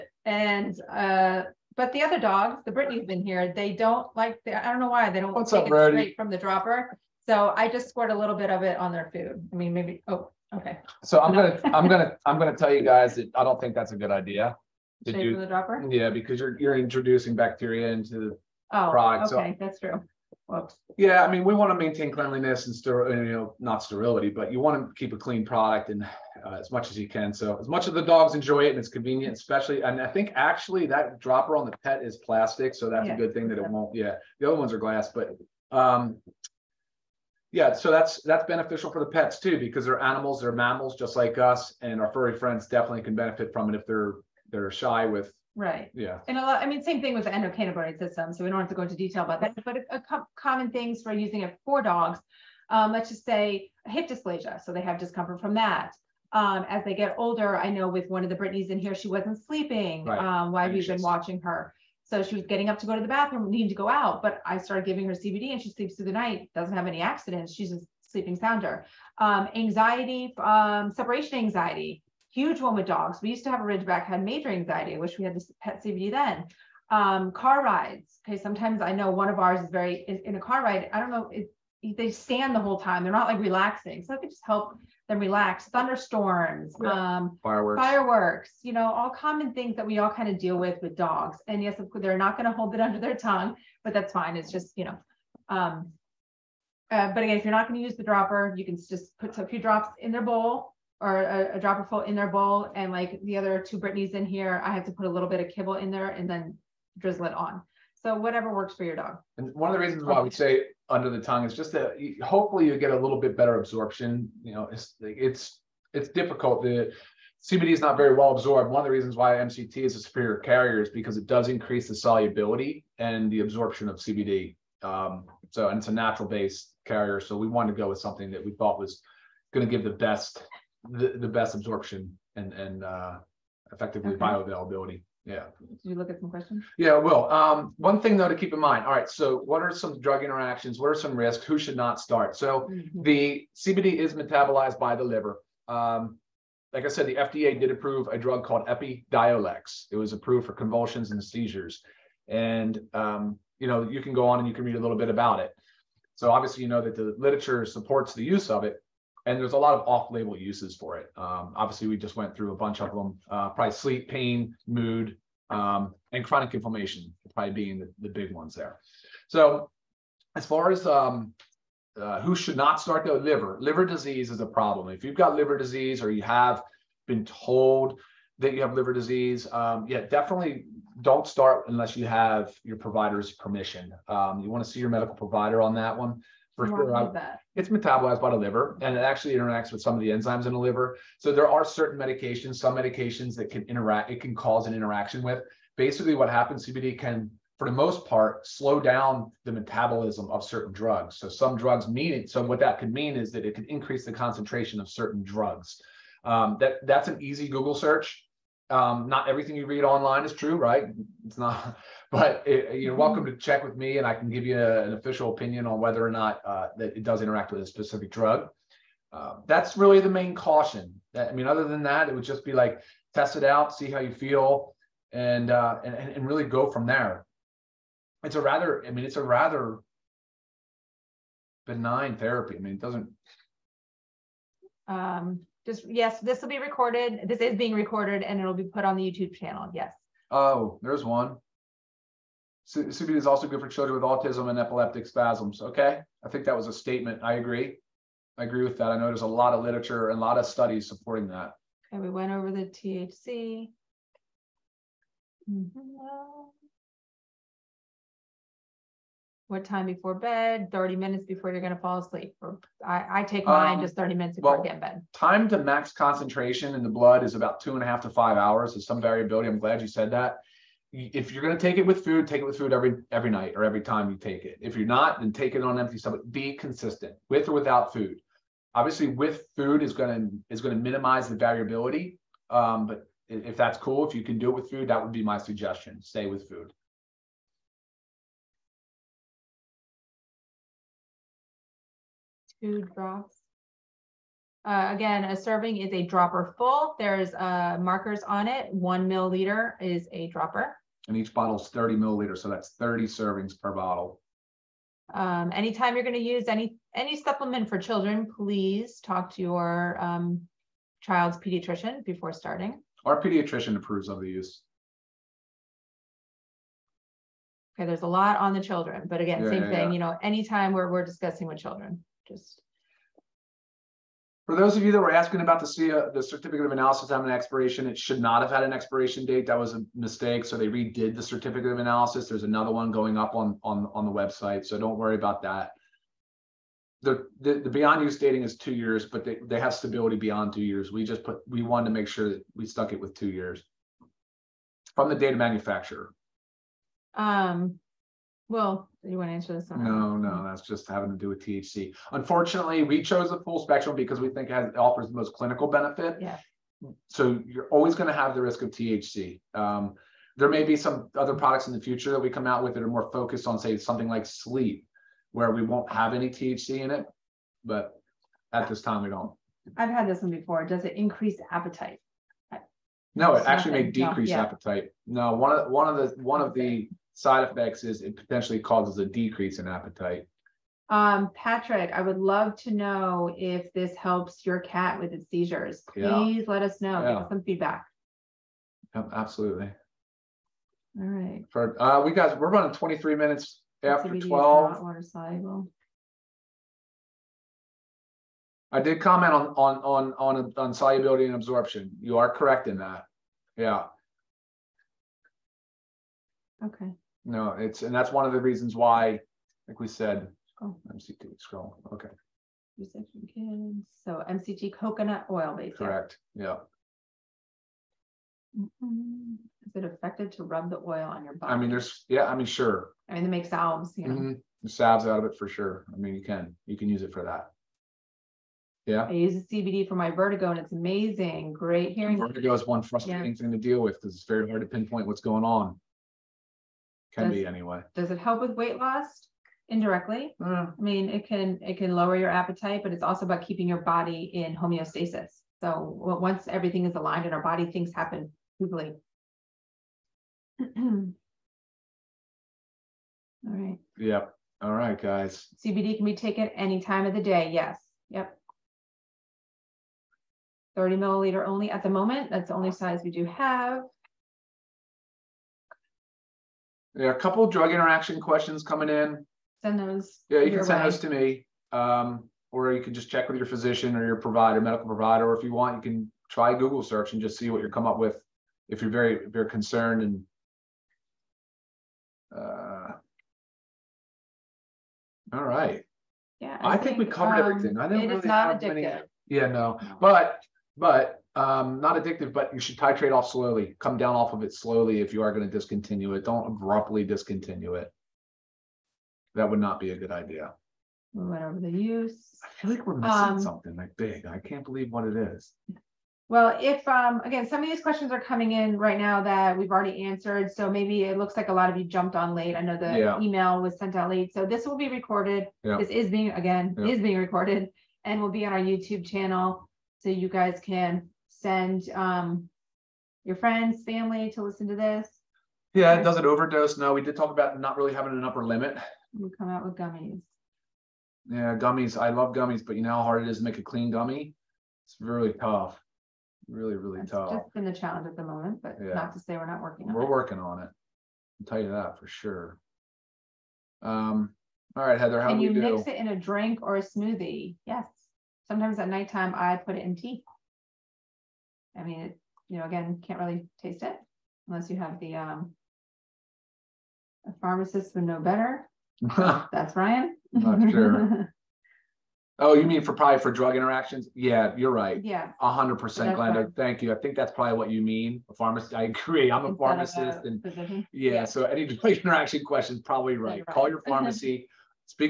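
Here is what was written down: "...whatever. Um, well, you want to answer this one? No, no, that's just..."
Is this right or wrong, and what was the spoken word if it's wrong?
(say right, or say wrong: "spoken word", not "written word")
wrong: "manufacturer", not "whatever".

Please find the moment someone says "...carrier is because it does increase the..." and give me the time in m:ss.
2:00.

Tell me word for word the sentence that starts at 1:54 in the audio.
You know, it's it's it's difficult.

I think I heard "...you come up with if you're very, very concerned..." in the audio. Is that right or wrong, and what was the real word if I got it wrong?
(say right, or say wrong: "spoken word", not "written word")
right.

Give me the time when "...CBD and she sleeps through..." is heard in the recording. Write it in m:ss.
1:05.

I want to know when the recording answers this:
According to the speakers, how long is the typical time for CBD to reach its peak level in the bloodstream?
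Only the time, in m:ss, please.
4:27.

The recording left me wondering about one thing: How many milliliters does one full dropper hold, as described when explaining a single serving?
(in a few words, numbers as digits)
1 milliliter.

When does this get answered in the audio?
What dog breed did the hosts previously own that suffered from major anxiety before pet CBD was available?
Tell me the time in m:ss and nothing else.
1:13.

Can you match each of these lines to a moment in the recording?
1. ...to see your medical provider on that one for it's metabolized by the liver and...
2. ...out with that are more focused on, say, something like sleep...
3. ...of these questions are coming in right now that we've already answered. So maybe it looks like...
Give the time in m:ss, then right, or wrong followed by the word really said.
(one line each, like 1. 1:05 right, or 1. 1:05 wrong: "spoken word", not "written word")
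1. 3:04 right
2. 6:02 right
3. 8:27 right.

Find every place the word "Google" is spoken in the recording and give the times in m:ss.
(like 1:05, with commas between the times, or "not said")
3:27, 7:56.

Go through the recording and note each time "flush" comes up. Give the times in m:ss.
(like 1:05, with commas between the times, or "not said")
not said.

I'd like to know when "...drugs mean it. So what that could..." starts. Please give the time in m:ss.
3:21.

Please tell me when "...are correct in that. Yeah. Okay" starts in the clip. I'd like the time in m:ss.
6:42.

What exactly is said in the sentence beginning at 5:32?
There's another one going up on on on the website.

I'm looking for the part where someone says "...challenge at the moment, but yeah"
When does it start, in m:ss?
8:57.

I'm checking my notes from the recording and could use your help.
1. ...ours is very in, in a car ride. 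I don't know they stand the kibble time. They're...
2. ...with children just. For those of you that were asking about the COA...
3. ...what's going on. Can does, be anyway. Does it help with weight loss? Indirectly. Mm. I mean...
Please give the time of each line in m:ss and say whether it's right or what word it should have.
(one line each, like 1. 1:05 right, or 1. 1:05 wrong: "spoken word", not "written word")
1. 1:19 wrong: "whole", not "kibble"
2. 5:21 right
3. 7:15 right.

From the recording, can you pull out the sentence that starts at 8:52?
I love gummies, but you know how hard it is to make a clean gummy?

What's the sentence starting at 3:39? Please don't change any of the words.
Uh, that's really the main caution.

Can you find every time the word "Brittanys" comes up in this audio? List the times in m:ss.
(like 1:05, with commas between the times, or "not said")
0:02, 0:58, 1:43.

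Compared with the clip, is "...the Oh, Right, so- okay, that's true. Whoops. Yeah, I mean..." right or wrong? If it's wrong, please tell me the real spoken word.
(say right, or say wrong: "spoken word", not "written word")
right.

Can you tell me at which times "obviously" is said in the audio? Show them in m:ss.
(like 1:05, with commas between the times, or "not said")
2:36, 2:41, 4:38.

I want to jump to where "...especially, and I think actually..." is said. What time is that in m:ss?
0:29.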